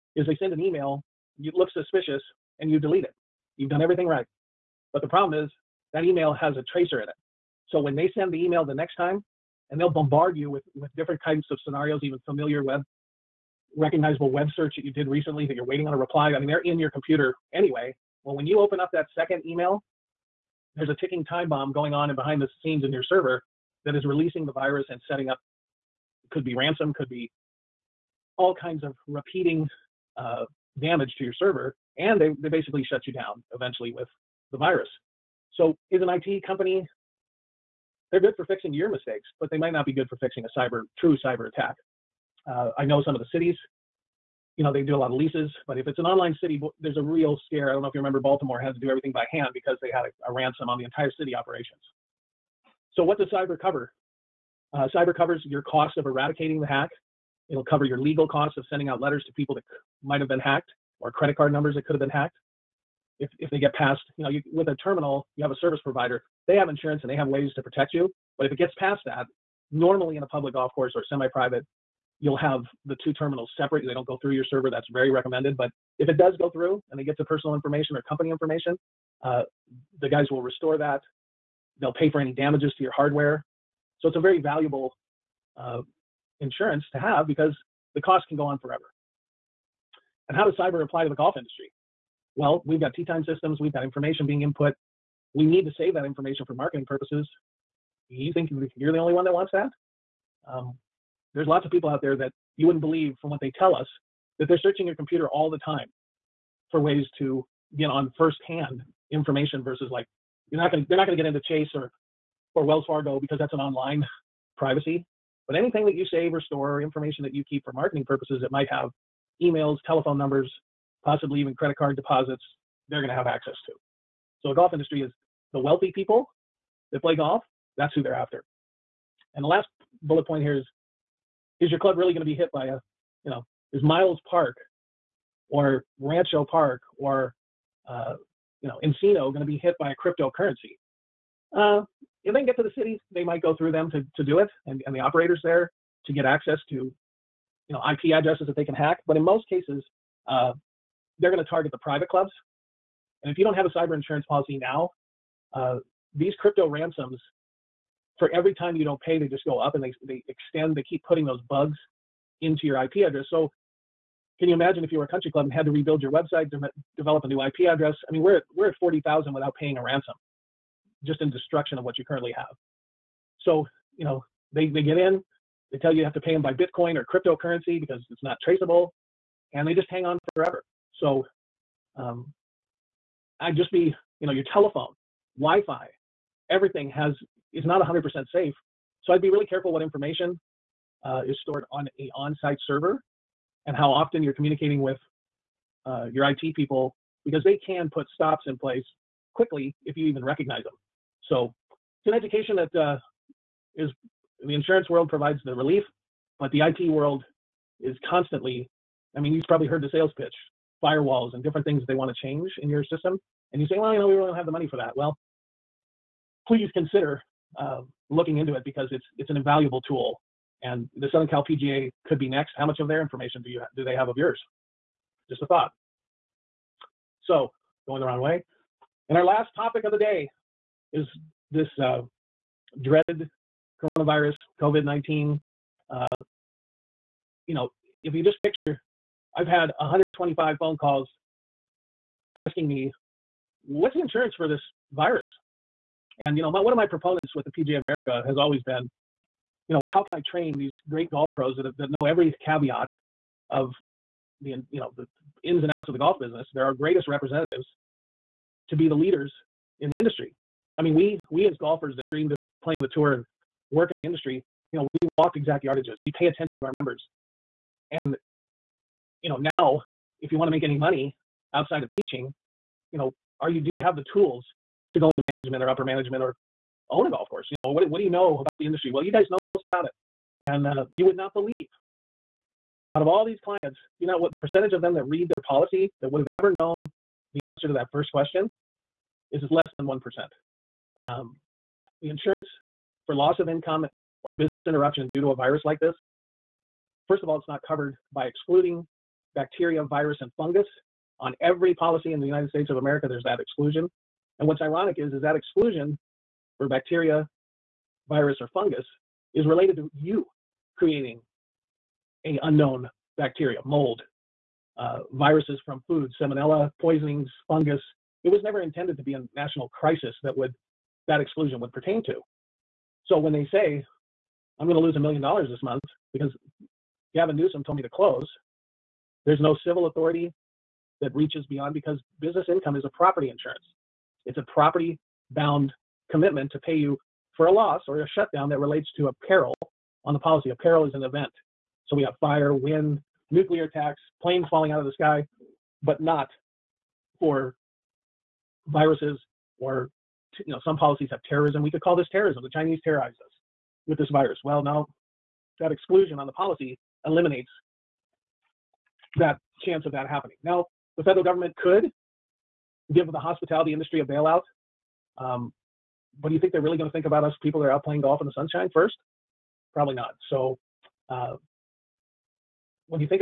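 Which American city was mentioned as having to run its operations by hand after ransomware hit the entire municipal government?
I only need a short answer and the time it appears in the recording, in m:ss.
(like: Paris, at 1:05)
Baltimore, at 0:48.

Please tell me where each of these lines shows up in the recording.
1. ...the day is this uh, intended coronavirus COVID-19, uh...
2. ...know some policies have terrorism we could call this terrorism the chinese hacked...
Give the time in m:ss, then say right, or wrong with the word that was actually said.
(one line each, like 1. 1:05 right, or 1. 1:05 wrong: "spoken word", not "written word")
1. 3:49 wrong: "dreaded", not "intended"
2. 5:50 wrong: "terrorized", not "hacked".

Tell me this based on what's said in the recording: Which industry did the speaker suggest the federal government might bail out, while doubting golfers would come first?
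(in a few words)
hospitality.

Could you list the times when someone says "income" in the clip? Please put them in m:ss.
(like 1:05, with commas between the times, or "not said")
4:53, 5:32.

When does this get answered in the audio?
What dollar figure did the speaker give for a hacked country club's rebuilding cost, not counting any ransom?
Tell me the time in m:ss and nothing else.
2:48.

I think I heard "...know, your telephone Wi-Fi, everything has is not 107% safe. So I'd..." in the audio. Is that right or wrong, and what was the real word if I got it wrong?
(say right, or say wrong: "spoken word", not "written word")
wrong: "100", not "107".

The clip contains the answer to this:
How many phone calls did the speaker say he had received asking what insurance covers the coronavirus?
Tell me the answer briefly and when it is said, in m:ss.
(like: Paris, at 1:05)
125, at 3:59.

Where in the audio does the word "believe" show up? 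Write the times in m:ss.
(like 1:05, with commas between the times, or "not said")
1:42, 4:41.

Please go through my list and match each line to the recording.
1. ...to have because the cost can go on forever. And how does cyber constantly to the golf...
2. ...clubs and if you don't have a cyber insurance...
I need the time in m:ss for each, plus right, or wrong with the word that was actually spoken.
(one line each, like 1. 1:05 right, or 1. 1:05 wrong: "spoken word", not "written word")
1. 1:26 wrong: "apply", not "constantly"
2. 2:32 right.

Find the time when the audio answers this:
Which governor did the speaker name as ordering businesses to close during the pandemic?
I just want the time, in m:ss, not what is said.
5:27.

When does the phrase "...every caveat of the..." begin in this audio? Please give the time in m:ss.
4:12.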